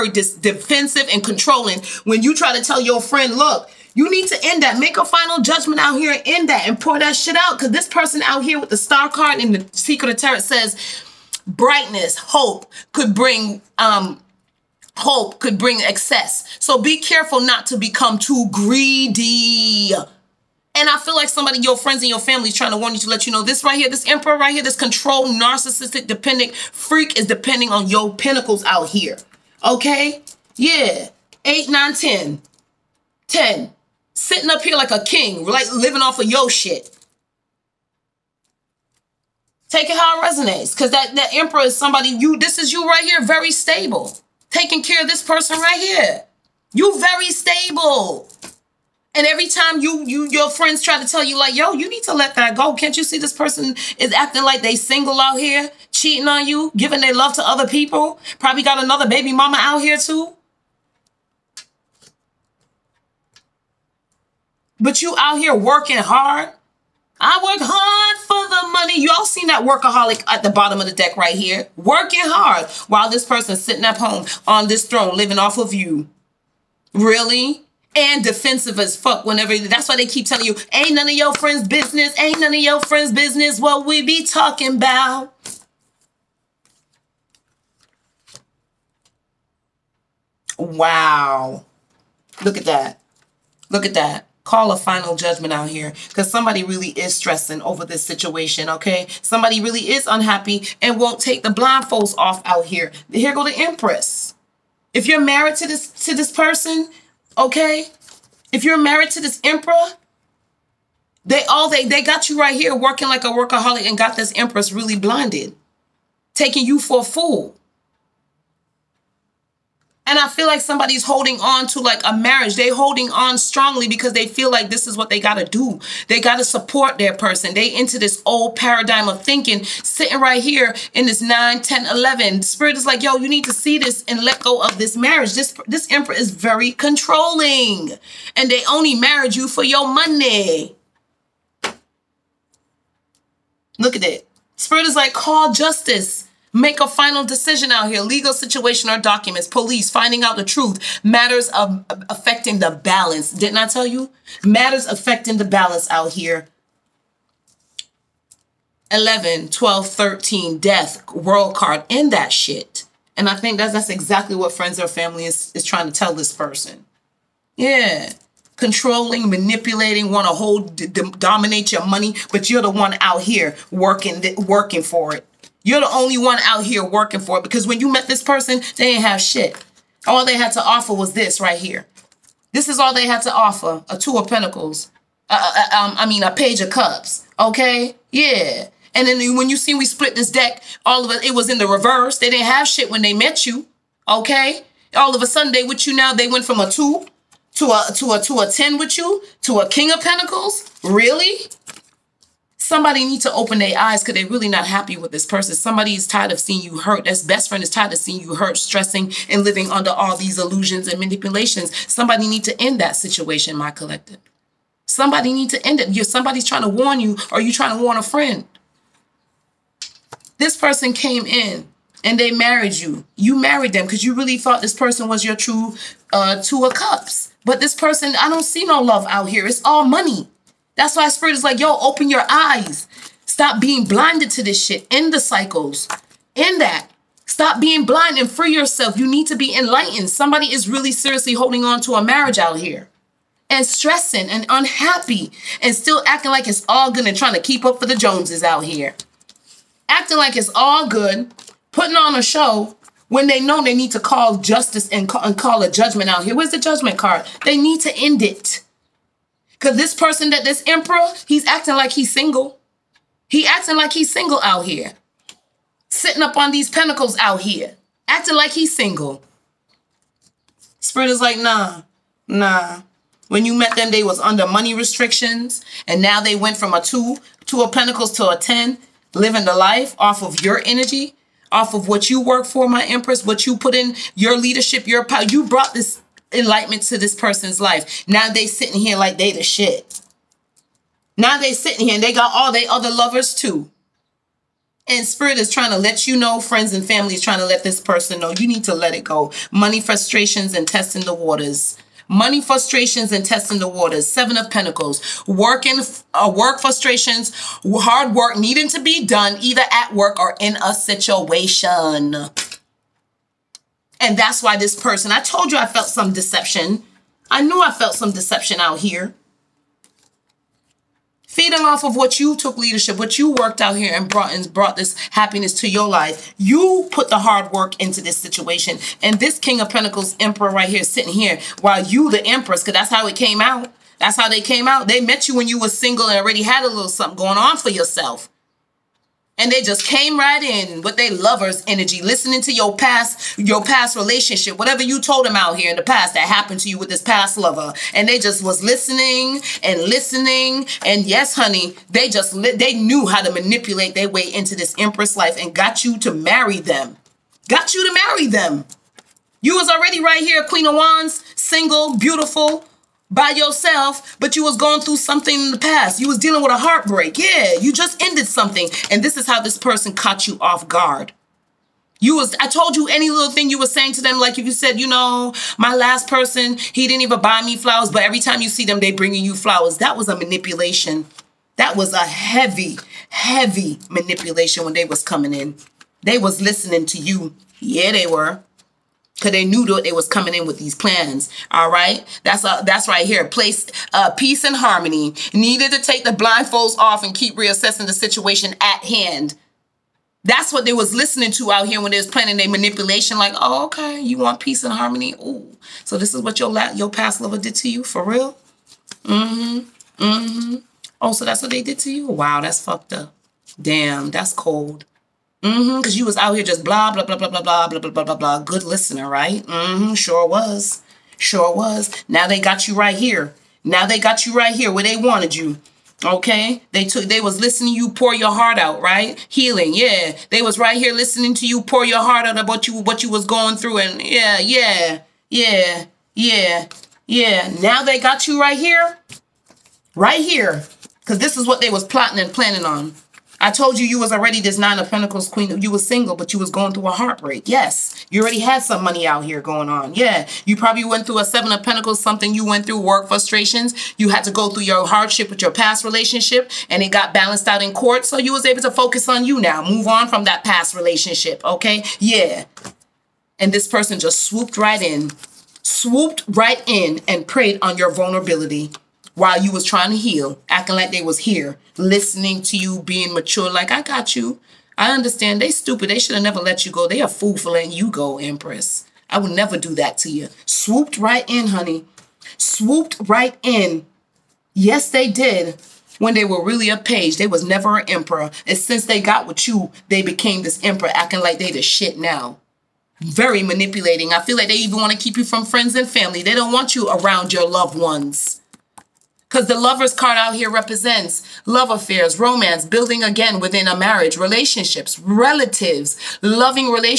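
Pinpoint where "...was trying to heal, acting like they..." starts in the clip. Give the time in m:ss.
7:49.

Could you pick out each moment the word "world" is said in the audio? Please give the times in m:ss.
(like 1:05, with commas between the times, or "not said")
2:41.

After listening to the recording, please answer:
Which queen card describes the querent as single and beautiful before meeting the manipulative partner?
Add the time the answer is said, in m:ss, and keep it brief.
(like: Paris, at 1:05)
queen of wands, at 6:00.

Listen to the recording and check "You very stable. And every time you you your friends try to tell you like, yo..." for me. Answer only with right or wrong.
right.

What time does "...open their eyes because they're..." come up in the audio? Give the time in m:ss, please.
3:23.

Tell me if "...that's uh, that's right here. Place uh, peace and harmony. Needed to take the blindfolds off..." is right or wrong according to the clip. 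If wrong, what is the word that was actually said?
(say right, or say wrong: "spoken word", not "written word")
right.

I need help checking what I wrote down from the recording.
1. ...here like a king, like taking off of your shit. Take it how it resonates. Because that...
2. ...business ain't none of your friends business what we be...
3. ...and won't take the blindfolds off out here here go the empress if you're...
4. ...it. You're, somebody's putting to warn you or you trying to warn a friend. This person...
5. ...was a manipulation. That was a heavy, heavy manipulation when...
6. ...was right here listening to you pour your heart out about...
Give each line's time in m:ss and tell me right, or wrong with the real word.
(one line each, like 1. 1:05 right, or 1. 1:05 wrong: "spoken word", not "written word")
1. 0:34 wrong: "living", not "taking"
2. 1:21 right
3. 1:40 right
4. 3:35 wrong: "trying", not "putting"
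5. 6:19 right
6. 7:10 right.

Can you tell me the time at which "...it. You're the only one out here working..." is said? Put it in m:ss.
2:55.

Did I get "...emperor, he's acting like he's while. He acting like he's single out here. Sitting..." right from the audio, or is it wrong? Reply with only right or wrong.
wrong.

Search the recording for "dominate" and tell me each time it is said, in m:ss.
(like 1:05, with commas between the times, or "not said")
2:51.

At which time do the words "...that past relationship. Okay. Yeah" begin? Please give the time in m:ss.
7:40.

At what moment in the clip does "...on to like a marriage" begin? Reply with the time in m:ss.
2:01.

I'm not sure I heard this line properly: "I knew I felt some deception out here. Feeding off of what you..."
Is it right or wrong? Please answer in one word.
right.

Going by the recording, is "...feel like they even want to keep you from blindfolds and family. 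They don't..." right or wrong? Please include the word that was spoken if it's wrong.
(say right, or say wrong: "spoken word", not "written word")
wrong: "friends", not "blindfolds".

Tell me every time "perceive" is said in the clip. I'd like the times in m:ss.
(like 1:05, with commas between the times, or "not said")
not said.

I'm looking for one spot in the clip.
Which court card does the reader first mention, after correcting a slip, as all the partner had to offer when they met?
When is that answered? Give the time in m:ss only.
3:06.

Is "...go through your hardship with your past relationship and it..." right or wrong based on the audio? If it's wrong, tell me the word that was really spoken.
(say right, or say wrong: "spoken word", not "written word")
right.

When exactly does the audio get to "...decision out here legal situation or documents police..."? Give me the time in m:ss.
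2:27.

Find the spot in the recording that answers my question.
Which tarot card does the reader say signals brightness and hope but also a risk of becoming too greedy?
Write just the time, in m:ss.
0:08.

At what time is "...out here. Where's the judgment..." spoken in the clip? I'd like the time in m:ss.
4:16.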